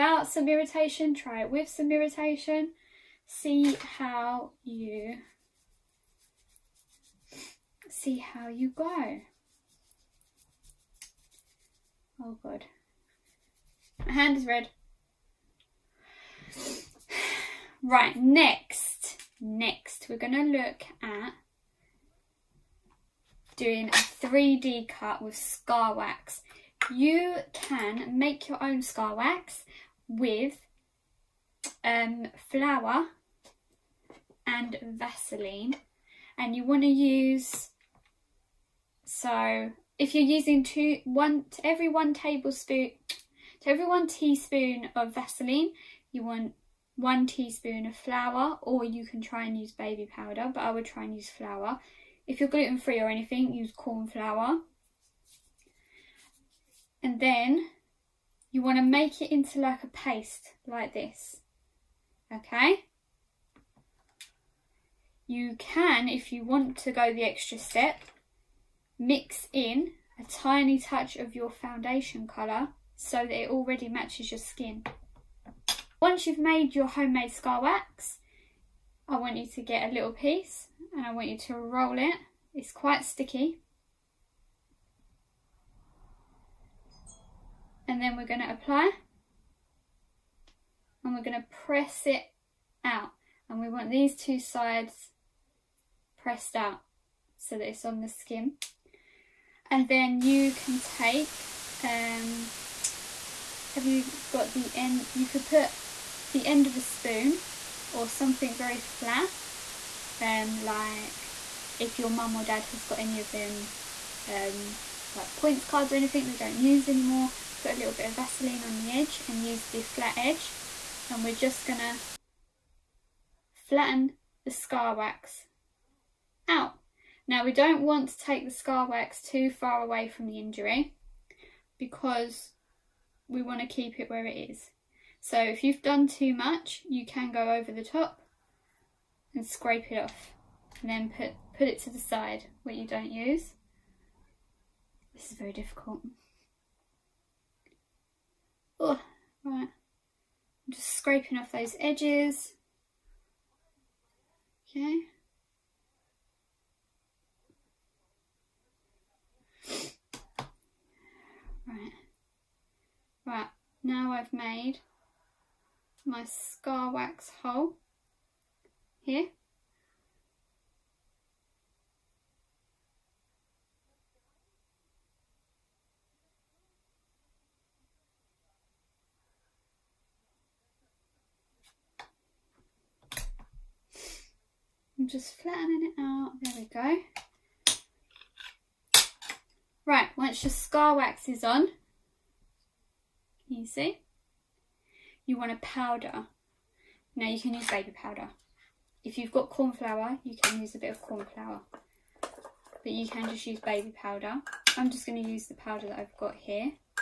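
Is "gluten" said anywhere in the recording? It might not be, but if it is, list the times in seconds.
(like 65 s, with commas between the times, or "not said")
52 s.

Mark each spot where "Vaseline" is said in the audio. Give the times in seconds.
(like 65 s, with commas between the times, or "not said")
34 s, 45 s, 118 s.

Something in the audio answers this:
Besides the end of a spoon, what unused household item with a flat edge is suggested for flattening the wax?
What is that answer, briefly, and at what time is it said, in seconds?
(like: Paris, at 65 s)
points cards, at 115 s.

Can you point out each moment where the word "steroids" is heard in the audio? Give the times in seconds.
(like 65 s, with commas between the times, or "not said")
not said.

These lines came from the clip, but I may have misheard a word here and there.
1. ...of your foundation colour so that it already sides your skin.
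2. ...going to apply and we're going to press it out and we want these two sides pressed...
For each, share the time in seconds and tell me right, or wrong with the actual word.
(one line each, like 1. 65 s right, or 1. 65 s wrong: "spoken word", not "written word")
1. 71 s wrong: "matches", not "sides"
2. 88 s right.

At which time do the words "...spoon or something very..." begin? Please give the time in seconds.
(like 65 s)
106 s.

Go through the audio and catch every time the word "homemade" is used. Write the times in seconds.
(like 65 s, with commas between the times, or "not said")
76 s.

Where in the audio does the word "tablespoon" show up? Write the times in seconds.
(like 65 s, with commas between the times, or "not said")
42 s.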